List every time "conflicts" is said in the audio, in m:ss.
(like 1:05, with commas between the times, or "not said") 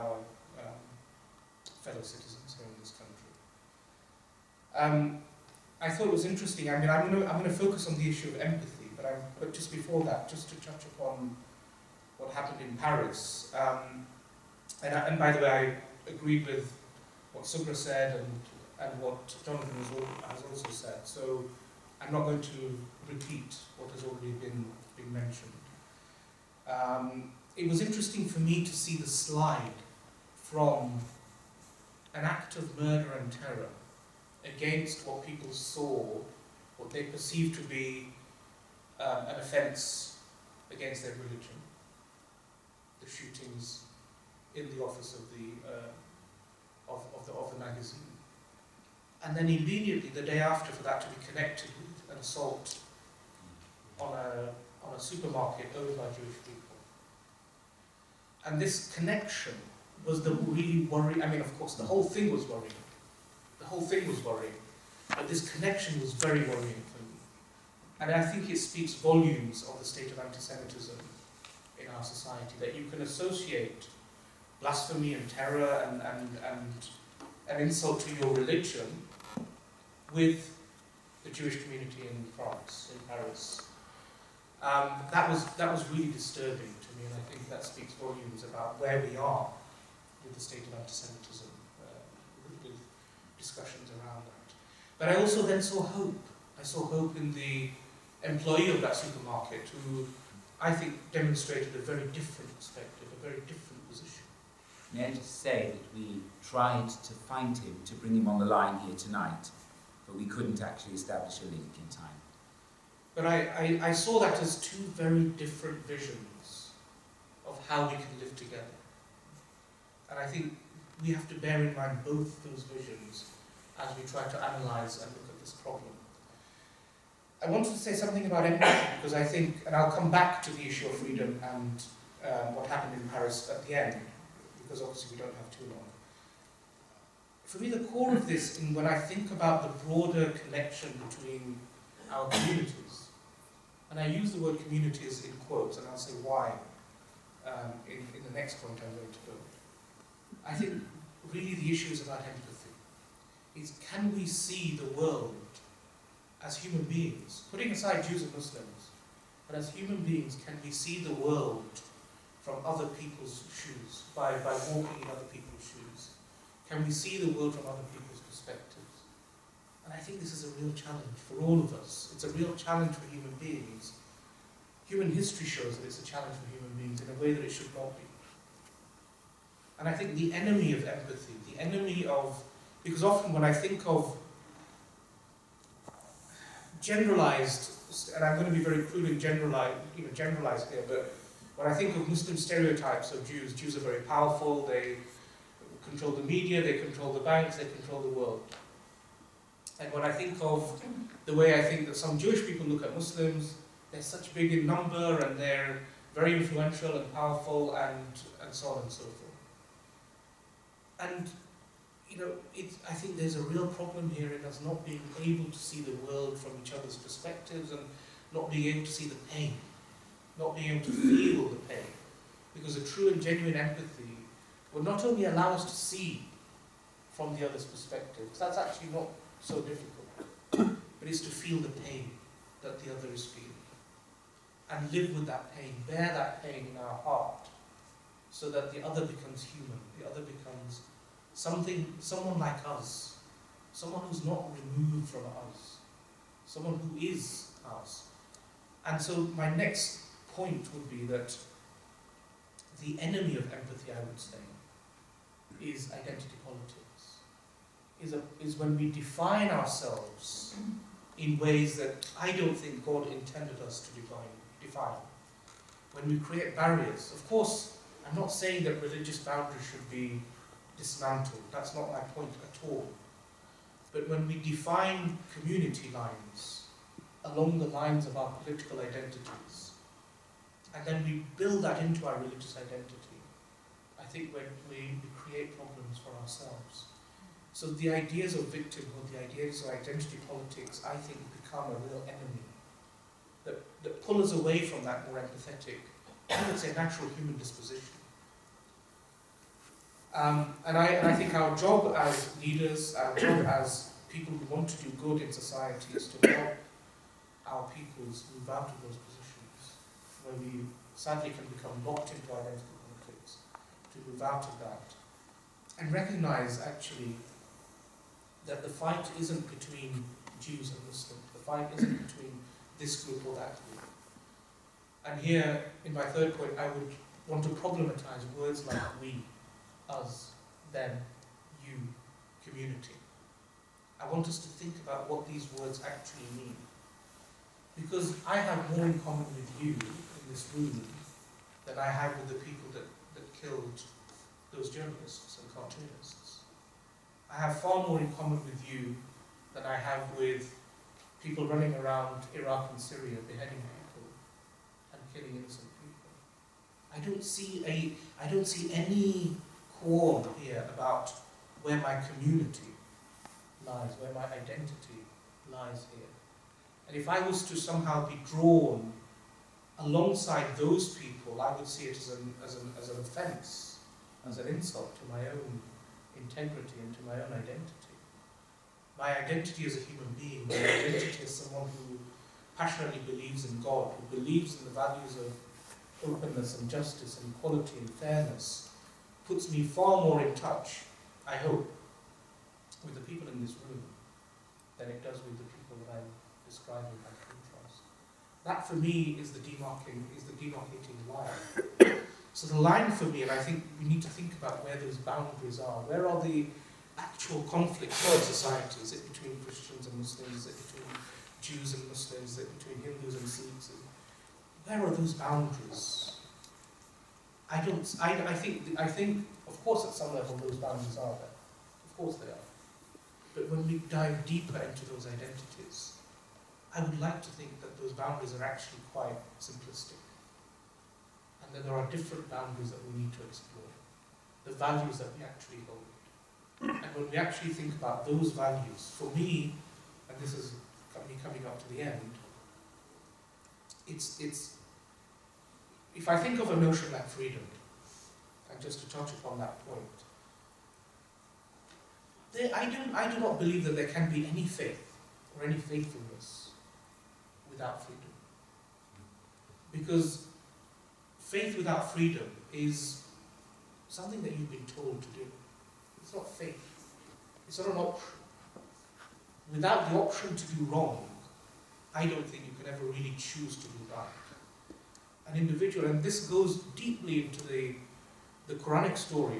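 5:12, 6:47.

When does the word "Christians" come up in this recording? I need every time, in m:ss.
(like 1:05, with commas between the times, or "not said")
6:49.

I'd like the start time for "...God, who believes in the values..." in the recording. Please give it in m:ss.
6:23.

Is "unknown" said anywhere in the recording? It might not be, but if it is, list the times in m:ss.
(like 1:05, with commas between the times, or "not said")
not said.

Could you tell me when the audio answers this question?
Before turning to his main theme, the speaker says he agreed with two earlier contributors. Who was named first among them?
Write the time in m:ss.
0:17.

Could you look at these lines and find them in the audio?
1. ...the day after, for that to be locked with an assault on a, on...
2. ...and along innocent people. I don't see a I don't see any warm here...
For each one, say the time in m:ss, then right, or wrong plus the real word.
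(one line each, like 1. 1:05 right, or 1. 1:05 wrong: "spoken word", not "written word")
1. 0:50 wrong: "connected", not "locked"
2. 5:54 wrong: "killing", not "along".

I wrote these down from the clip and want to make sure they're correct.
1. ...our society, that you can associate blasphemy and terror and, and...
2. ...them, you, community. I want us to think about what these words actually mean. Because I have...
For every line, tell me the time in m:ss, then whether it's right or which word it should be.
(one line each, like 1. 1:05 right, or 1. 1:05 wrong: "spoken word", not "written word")
1. 1:11 right
2. 5:30 right.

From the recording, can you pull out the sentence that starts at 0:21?
So I'm not going to repeat what has already been been mentioned.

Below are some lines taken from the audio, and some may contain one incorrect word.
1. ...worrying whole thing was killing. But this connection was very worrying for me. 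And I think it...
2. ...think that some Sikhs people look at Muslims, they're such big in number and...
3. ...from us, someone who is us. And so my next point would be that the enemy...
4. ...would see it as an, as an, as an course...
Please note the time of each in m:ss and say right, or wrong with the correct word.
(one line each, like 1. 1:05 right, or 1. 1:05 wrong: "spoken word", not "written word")
1. 1:02 wrong: "worrying", not "killing"
2. 3:21 wrong: "Jewish", not "Sikhs"
3. 4:05 right
4. 6:11 wrong: "offense", not "course".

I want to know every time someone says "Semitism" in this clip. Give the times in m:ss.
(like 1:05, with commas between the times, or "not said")
1:10, 1:30.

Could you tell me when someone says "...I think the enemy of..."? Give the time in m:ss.
2:59.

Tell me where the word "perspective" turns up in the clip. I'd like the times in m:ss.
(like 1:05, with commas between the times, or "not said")
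1:42, 2:48, 3:36, 3:47.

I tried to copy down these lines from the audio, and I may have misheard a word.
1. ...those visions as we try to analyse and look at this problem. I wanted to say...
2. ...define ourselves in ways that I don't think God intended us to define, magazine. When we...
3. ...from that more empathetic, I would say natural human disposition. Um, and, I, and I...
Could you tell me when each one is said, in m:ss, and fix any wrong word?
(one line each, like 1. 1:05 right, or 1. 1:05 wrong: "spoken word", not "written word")
1. 2:02 right
2. 4:18 wrong: "define", not "magazine"
3. 4:54 right.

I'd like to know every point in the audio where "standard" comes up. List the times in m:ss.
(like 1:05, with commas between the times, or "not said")
not said.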